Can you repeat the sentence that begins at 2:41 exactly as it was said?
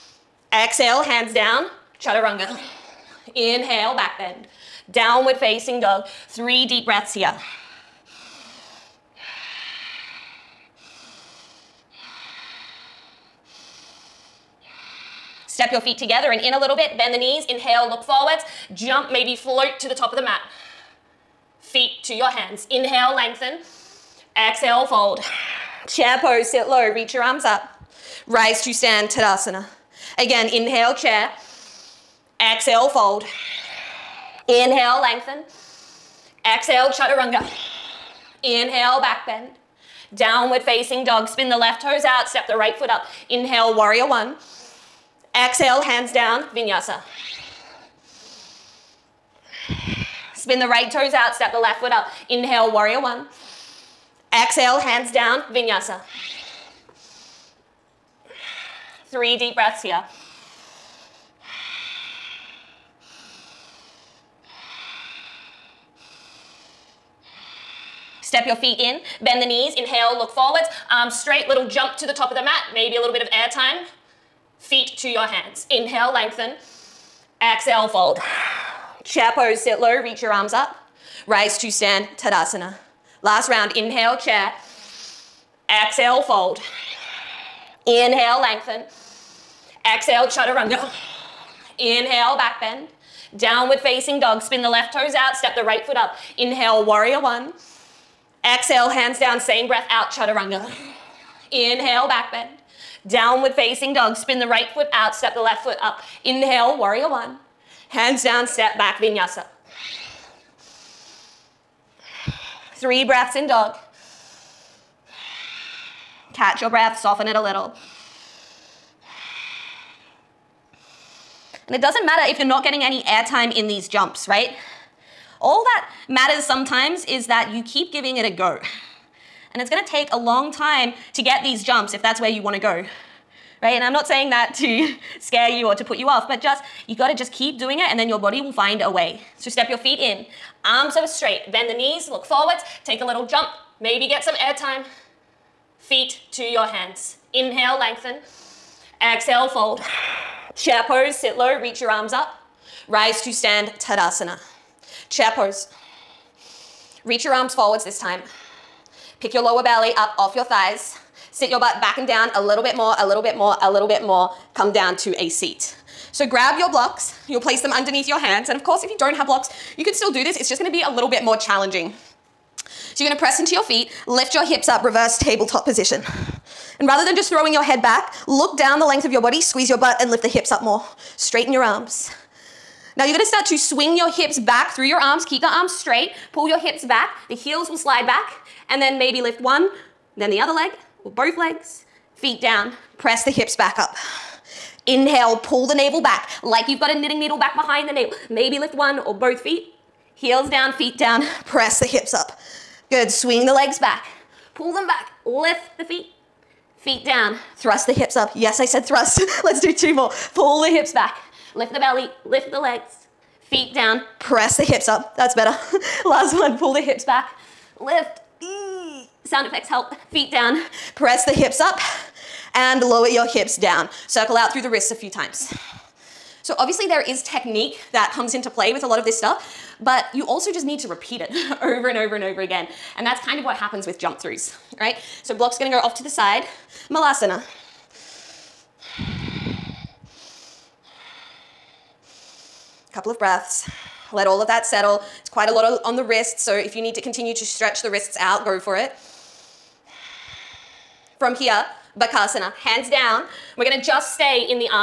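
Sit your butt back and down a little bit more, a little bit more, a little bit more.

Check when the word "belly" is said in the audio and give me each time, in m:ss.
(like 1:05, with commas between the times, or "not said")
2:39, 3:31.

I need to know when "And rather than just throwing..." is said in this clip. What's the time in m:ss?
2:56.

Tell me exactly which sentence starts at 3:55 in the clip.
So block's gonna go off to the side.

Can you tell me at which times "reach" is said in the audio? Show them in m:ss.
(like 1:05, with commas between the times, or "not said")
0:26, 1:20, 2:31, 2:37.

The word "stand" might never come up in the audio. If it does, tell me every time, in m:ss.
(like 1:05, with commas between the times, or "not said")
0:28, 1:21, 2:33.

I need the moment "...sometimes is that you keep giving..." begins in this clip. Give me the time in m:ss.
2:06.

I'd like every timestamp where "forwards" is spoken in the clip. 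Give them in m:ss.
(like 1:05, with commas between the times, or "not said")
0:18, 1:10, 2:22, 2:37.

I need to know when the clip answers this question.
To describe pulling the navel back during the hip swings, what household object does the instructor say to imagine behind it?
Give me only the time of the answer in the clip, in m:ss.
3:16.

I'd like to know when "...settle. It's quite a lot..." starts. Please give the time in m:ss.
4:04.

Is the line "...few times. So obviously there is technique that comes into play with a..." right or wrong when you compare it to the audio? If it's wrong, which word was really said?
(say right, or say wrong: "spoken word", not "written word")
right.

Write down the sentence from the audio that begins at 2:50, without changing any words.
It's just gonna be a little bit more challenging.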